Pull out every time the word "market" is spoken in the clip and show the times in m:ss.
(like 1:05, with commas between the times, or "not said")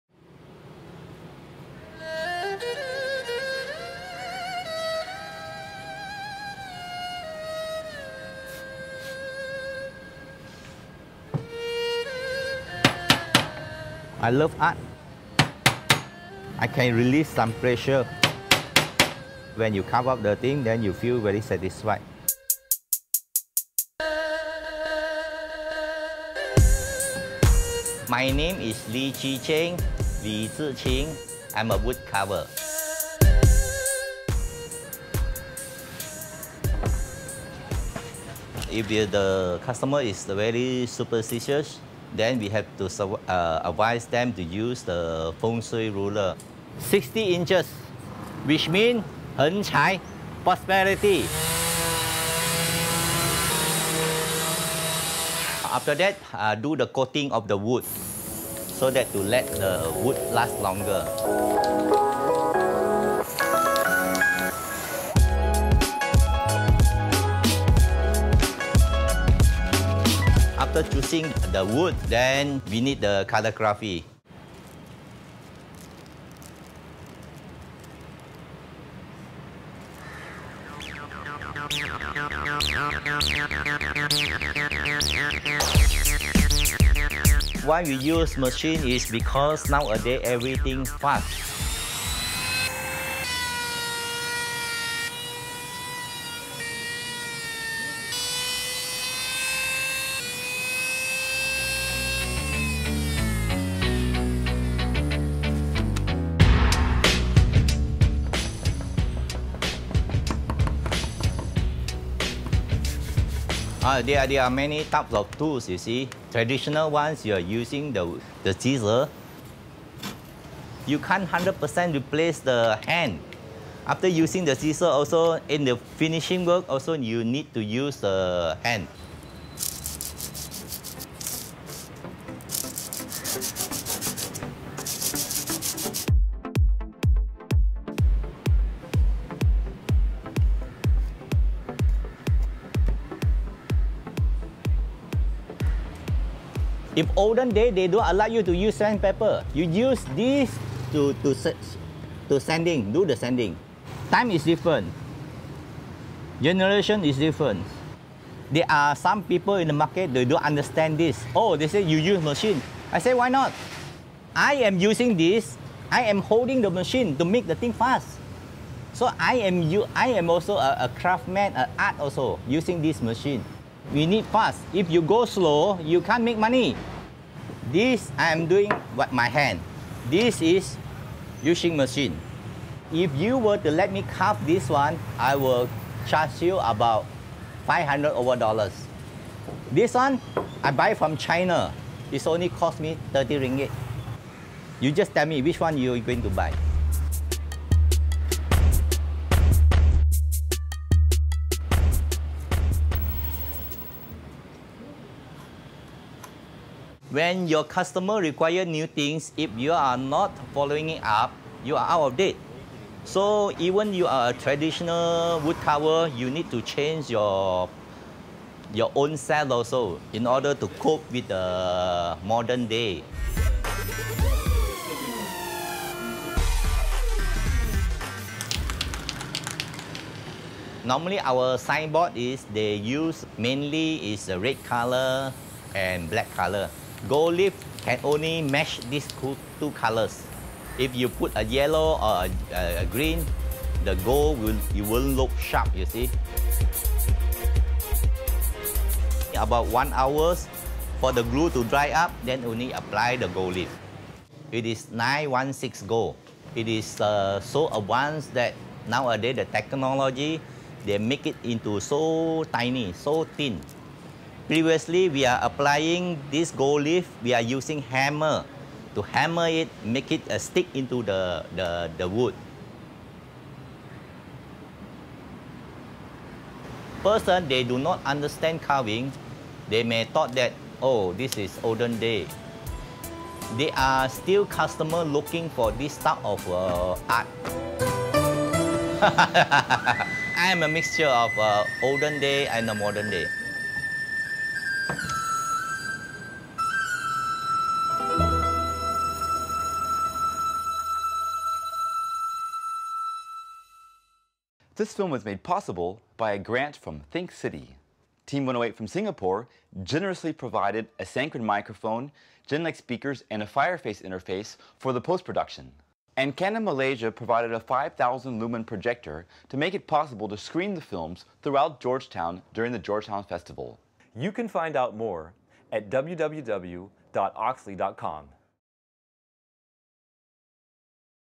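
2:39.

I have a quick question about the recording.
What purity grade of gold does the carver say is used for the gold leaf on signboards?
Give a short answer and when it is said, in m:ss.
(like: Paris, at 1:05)
916, at 4:14.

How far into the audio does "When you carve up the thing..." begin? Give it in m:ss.
0:19.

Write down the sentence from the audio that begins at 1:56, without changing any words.
Traditional ones, you are using the, the scissor.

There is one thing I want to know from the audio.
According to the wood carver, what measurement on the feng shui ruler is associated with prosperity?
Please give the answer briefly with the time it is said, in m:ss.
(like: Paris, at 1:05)
60 inches, at 0:46.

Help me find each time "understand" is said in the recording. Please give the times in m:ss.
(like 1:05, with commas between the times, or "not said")
2:40, 4:38.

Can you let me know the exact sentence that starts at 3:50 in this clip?
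Normally our signboard is they use mainly is red color and black color.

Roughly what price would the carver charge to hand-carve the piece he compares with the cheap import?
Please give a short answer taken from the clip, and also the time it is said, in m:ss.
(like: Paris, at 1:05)
500 dollars, at 3:07.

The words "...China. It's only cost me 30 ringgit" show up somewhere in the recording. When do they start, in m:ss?
3:11.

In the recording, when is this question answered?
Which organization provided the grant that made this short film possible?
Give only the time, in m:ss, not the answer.
5:07.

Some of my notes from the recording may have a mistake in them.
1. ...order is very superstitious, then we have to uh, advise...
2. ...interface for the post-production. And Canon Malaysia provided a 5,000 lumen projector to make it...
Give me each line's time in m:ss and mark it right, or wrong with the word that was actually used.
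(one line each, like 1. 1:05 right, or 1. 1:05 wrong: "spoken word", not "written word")
1. 0:39 wrong: "customer", not "order"
2. 5:14 right.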